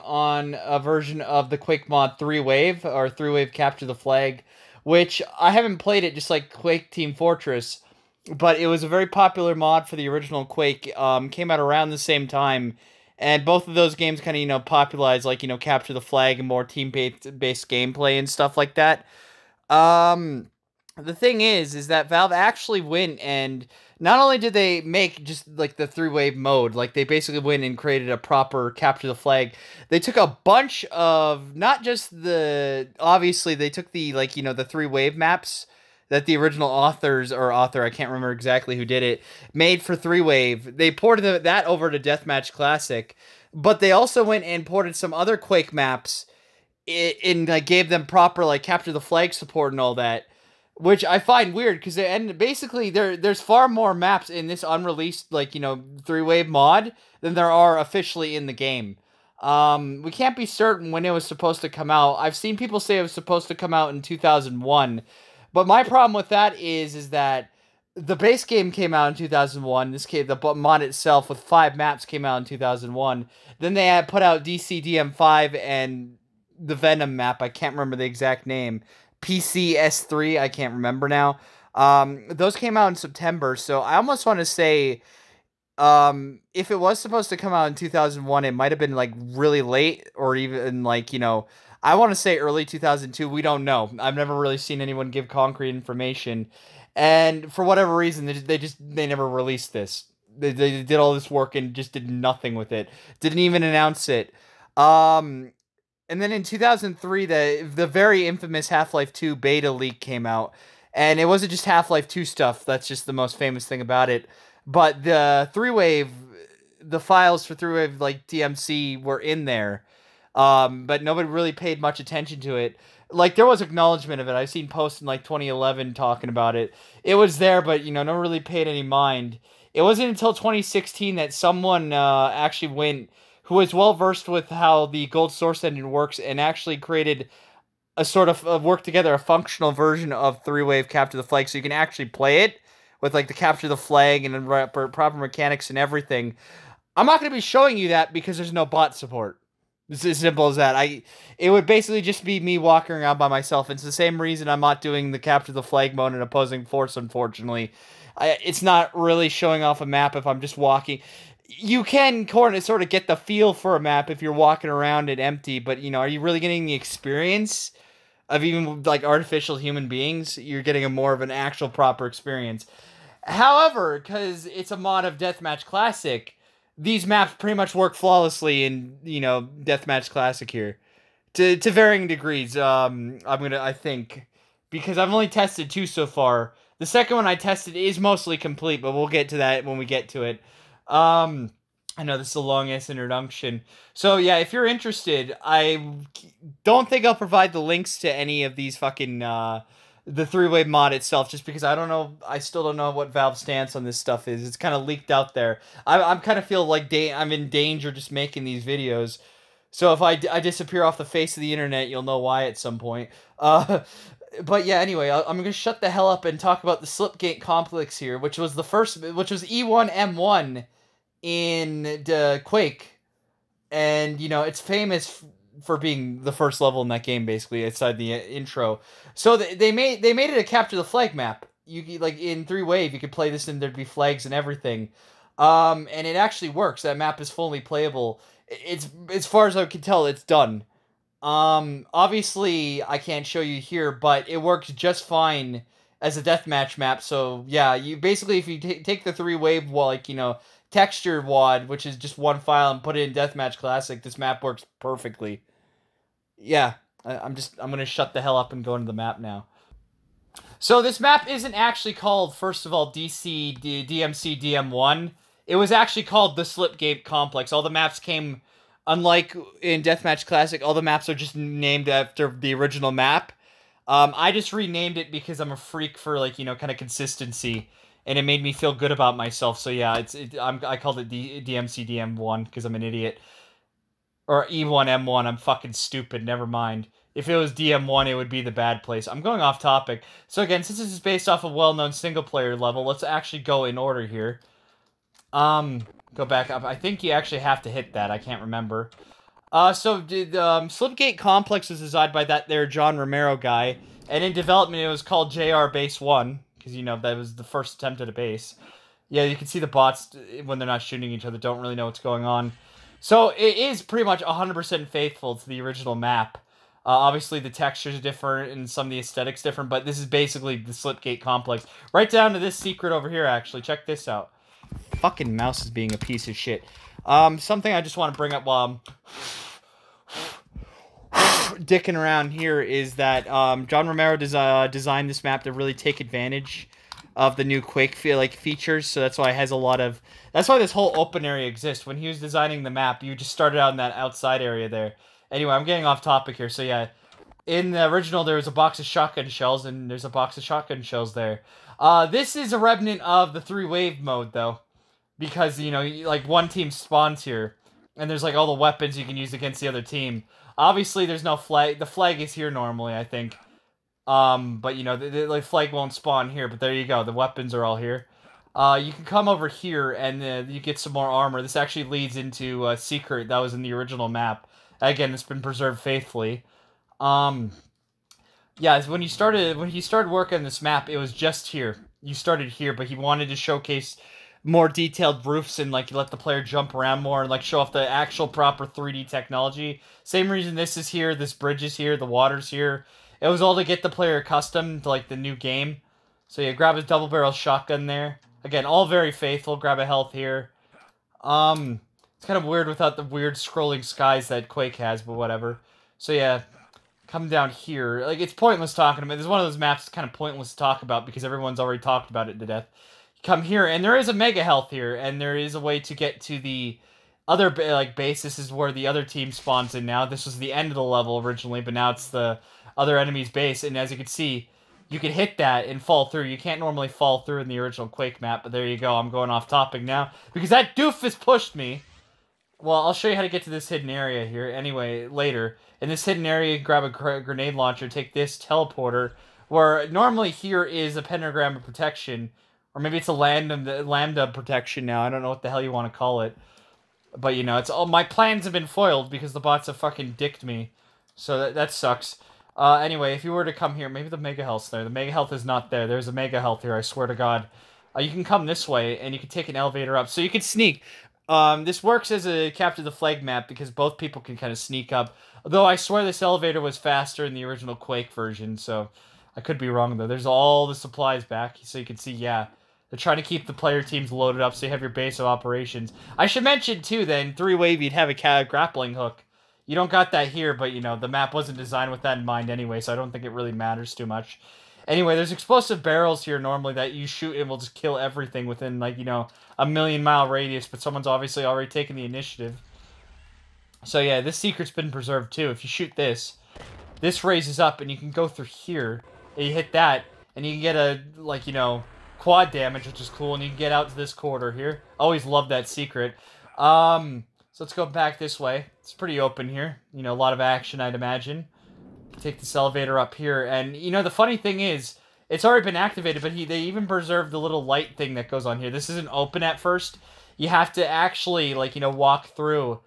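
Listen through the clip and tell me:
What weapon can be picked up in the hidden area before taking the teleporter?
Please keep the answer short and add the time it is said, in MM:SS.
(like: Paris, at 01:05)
Grenade launcher, at 07:17.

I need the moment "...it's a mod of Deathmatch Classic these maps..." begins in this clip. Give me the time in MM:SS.
02:54.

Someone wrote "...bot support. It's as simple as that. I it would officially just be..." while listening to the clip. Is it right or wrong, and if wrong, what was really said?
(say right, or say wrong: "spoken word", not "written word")
wrong: "basically", not "officially".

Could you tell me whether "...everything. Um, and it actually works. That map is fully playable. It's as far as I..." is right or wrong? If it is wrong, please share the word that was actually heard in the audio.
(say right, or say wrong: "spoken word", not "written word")
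right.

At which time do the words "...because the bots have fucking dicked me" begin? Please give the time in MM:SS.
07:29.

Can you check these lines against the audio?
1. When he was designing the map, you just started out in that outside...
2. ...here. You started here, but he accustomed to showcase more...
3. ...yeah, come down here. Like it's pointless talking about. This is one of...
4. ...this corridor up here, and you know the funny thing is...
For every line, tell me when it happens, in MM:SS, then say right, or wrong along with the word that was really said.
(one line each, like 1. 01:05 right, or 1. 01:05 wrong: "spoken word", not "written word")
1. 05:41 right
2. 06:21 wrong: "wanted", not "accustomed"
3. 06:46 right
4. 08:32 wrong: "elevator", not "corridor".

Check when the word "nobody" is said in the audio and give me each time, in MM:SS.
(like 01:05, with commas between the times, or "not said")
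02:01.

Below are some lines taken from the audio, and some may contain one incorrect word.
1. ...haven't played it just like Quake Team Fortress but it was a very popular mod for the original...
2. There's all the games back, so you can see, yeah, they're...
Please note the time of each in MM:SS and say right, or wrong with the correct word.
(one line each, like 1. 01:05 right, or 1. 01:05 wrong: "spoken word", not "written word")
1. 00:05 right
2. 07:50 wrong: "supplies", not "games".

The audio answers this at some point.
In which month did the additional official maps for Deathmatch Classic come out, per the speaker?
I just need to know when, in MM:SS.
01:22.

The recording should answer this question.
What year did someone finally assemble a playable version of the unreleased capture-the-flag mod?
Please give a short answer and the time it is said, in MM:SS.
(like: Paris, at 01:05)
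2016, at 02:10.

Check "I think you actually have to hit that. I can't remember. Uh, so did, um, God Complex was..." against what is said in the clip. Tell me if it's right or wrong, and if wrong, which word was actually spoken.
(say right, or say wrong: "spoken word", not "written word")
wrong: "Slipgate", not "God".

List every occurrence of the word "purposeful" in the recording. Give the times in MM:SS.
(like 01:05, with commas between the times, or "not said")
not said.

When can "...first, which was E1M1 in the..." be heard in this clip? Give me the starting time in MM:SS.
03:38.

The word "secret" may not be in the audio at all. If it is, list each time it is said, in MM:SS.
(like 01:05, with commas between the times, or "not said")
05:22, 06:12, 08:14, 08:25.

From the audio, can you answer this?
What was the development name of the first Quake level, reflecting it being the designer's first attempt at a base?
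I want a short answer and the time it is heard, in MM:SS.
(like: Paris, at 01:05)
JR Base One, at 05:05.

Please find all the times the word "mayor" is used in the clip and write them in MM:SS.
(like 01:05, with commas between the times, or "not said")
not said.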